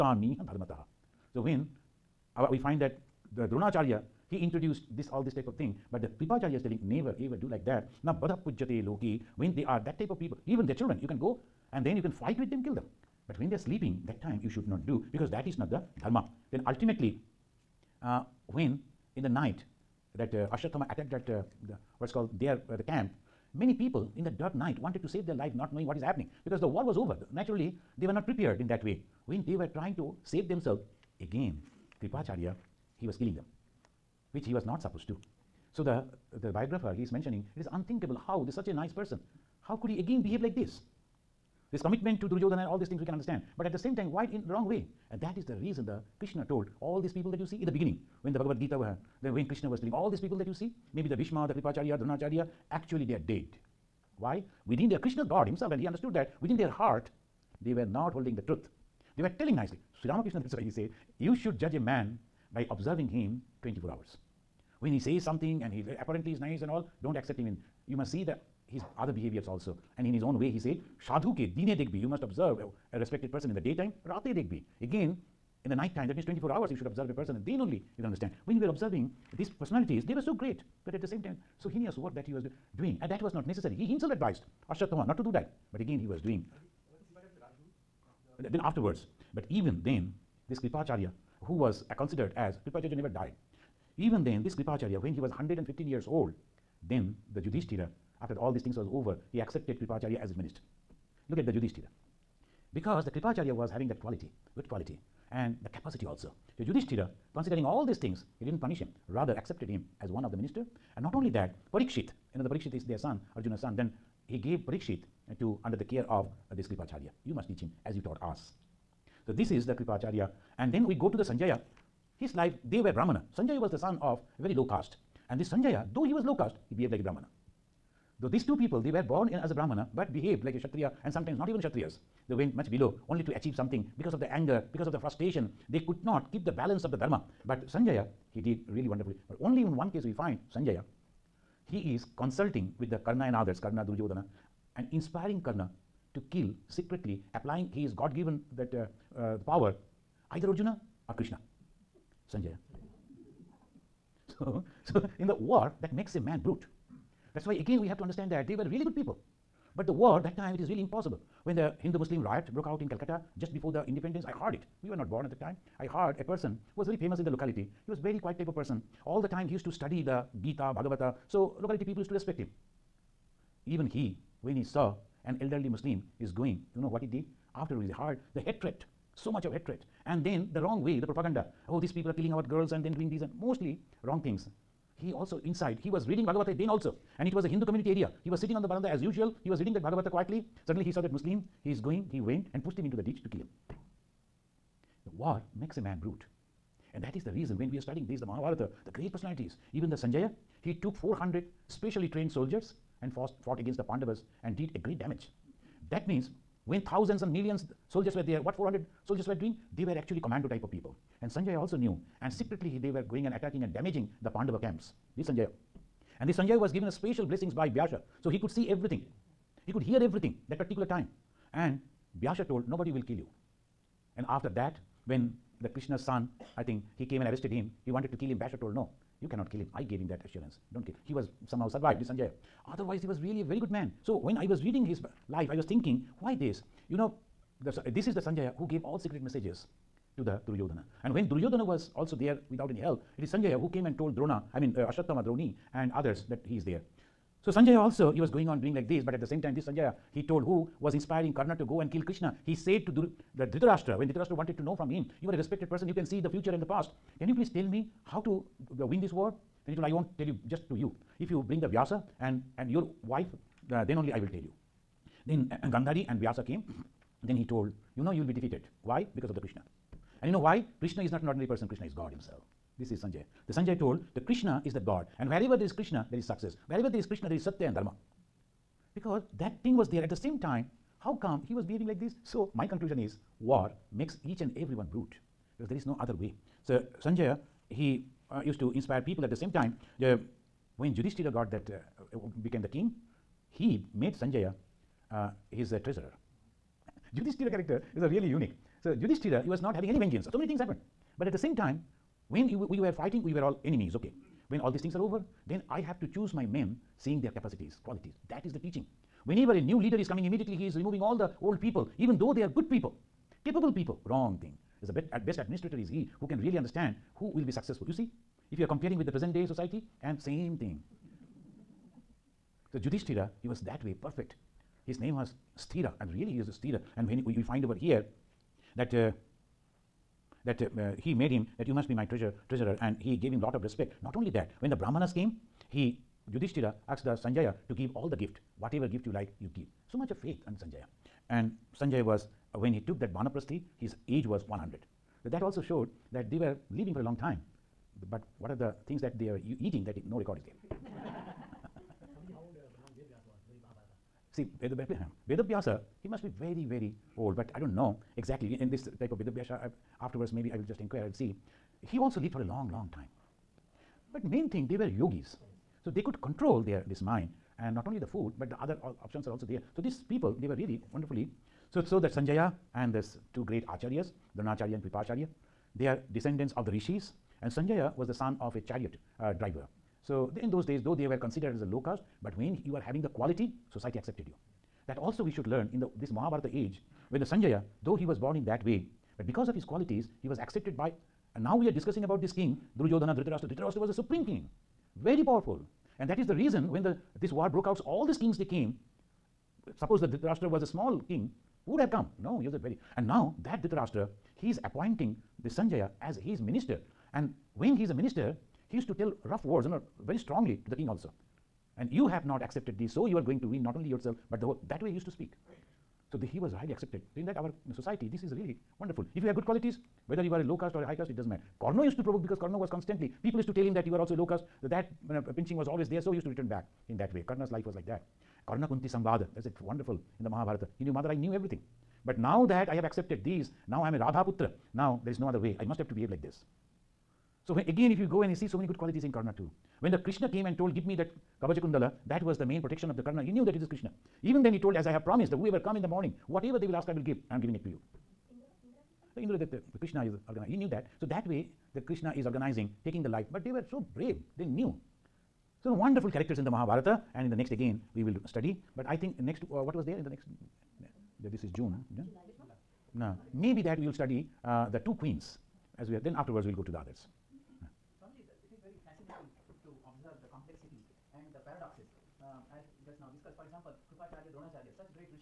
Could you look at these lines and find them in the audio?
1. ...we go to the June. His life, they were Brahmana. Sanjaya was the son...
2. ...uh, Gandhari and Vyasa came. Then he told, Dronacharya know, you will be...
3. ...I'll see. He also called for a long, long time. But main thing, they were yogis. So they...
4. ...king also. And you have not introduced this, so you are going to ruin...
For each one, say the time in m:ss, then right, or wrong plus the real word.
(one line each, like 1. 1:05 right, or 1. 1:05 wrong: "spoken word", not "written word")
1. 2:00 wrong: "Sanjaya", not "June"
2. 4:25 wrong: "You", not "Dronacharya"
3. 6:01 wrong: "lived", not "called"
4. 6:50 wrong: "accepted", not "introduced".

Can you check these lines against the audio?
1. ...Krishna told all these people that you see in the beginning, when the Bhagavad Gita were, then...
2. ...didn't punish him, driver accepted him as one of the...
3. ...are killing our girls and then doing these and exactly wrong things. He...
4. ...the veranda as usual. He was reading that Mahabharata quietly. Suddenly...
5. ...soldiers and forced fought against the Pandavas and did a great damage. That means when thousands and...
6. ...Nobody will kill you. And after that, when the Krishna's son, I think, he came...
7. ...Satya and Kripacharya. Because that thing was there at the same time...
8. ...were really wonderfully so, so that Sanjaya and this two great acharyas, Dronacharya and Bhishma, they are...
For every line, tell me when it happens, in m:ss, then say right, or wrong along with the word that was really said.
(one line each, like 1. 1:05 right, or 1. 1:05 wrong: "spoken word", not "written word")
1. 0:46 right
2. 1:48 wrong: "rather", not "driver"
3. 3:02 wrong: "mostly", not "exactly"
4. 3:08 wrong: "Bhagavata", not "Mahabharata"
5. 3:22 right
6. 3:42 right
7. 4:37 wrong: "Dharma", not "Kripacharya"
8. 6:10 wrong: "Kripacharya", not "Bhishma".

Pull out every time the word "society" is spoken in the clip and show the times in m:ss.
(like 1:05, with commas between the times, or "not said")
5:19, 6:23, 6:57.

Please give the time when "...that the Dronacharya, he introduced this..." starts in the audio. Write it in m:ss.
0:02.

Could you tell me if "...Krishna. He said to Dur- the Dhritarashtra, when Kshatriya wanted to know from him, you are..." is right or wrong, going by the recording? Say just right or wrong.
wrong.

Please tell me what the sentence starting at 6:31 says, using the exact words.
And now we are discussing about this king, Duryodhana, Dhritarashtra.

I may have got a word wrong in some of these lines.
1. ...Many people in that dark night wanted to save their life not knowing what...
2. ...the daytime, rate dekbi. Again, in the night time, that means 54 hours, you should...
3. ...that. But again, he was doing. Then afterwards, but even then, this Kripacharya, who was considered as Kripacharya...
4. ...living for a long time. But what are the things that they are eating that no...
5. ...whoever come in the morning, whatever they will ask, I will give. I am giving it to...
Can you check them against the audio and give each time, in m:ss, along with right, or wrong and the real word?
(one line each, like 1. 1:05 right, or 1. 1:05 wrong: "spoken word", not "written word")
1. 0:23 right
2. 1:13 wrong: "24", not "54"
3. 1:25 right
4. 5:46 right
5. 7:25 right.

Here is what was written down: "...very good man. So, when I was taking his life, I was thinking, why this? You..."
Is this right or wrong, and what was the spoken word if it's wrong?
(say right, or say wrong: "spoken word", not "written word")
wrong: "reading", not "taking".